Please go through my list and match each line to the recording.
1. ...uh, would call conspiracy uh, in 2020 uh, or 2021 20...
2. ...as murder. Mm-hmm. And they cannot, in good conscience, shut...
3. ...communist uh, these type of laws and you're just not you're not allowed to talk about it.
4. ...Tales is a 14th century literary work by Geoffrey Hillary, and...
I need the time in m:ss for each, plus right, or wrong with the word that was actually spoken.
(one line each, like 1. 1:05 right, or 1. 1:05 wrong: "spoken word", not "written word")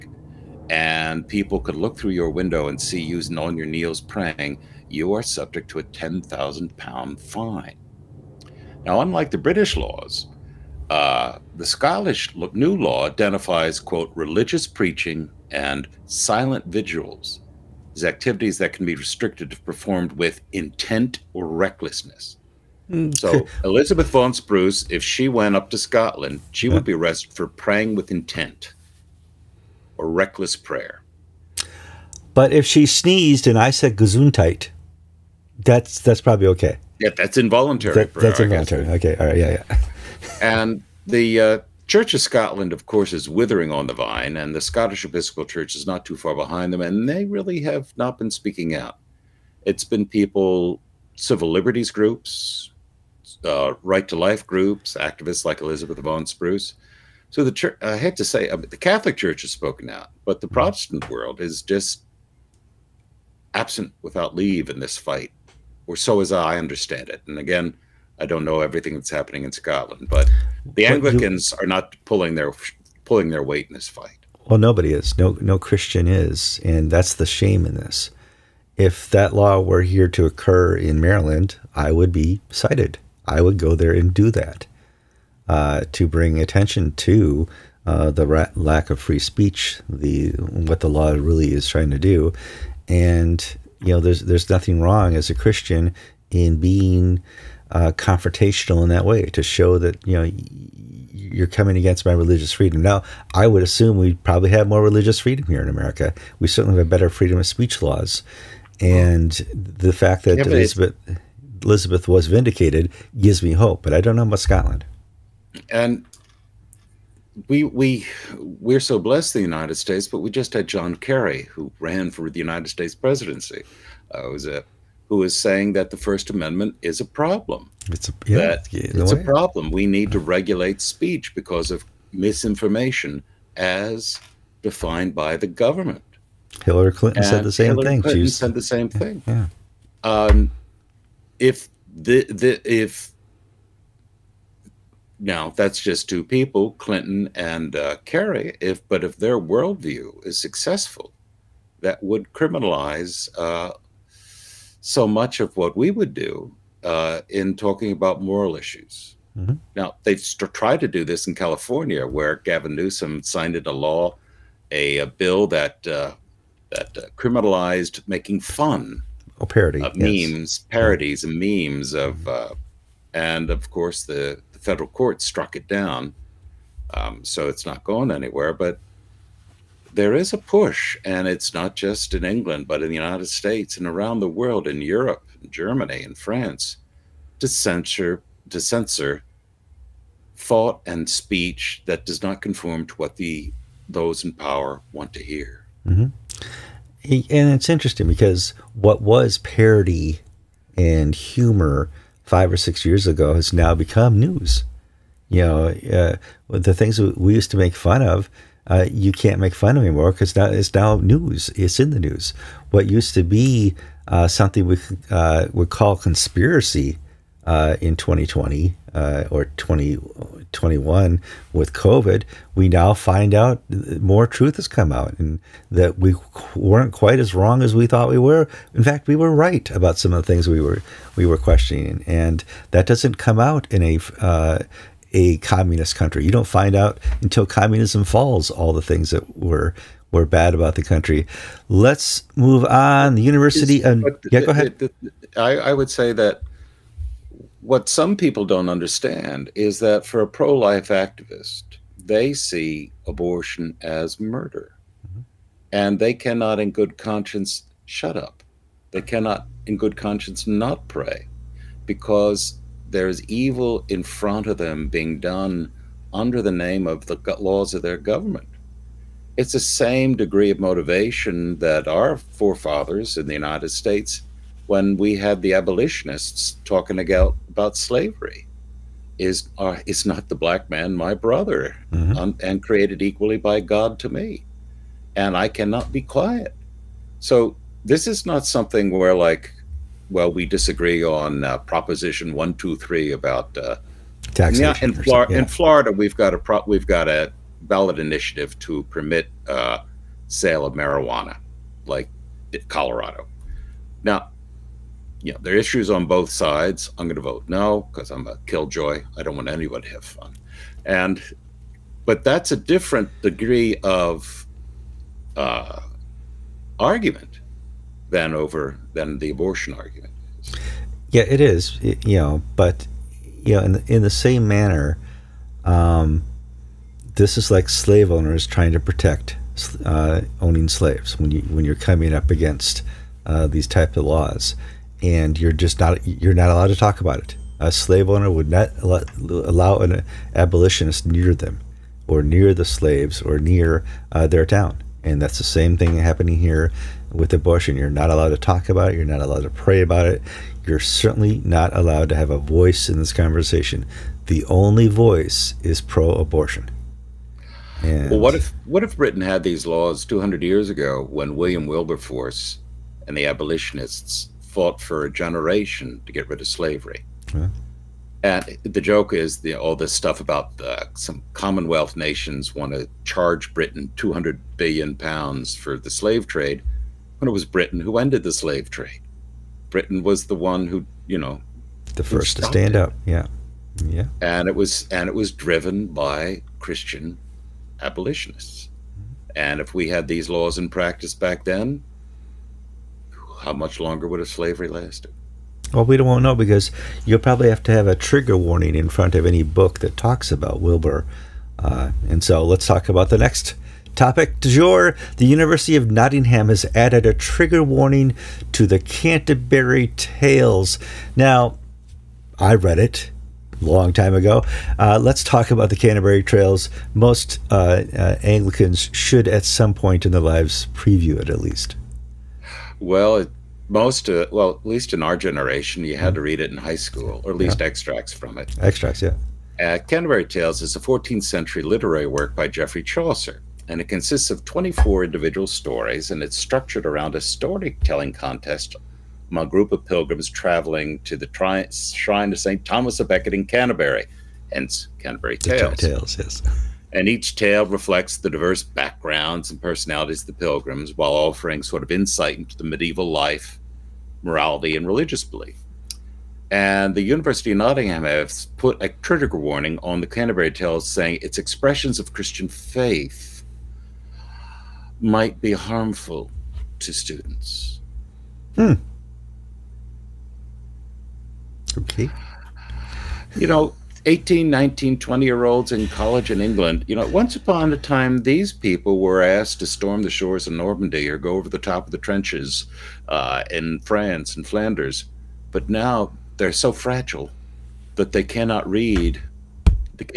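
1. 3:35 right
2. 4:13 right
3. 5:32 wrong: "against", not "communist"
4. 7:10 wrong: "Chaucer", not "Hillary".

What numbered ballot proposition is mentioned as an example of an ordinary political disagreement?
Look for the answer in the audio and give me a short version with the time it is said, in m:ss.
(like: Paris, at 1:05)
Proposition 123, at 4:51.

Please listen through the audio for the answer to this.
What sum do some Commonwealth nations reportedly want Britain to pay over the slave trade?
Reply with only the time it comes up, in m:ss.
6:13.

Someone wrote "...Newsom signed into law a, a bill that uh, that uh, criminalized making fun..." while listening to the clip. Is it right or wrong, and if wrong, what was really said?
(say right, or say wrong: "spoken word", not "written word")
right.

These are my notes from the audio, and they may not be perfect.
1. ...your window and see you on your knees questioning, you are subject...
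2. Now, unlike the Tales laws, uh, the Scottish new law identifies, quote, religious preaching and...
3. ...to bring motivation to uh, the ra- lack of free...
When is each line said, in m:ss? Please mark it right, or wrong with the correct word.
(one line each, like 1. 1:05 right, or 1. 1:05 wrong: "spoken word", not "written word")
1. 0:02 wrong: "praying", not "questioning"
2. 0:08 wrong: "British", not "Tales"
3. 1:25 wrong: "attention", not "motivation".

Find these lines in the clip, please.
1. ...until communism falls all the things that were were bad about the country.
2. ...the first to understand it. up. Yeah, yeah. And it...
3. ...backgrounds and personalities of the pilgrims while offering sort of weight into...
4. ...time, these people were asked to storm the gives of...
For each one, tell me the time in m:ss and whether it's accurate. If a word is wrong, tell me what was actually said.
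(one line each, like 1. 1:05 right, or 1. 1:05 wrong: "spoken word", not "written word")
1. 3:57 right
2. 6:21 wrong: "stand", not "understand"
3. 7:28 wrong: "insight", not "weight"
4. 7:57 wrong: "shores", not "gives".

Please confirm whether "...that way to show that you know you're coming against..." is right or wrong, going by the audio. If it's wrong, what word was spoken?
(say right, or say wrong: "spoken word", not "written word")
right.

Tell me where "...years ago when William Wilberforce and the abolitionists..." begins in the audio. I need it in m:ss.
6:00.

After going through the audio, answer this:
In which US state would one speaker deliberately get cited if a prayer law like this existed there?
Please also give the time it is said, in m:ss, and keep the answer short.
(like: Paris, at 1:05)
Maryland, at 1:20.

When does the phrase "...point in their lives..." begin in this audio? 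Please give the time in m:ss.
6:59.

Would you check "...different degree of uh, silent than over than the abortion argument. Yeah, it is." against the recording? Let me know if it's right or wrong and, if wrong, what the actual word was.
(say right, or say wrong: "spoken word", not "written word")
wrong: "argument", not "silent".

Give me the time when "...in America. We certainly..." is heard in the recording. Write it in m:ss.
1:45.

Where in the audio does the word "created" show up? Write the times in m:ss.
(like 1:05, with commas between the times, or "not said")
4:42.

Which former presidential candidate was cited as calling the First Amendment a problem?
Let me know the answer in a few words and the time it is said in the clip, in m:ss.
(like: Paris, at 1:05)
John Kerry, at 2:00.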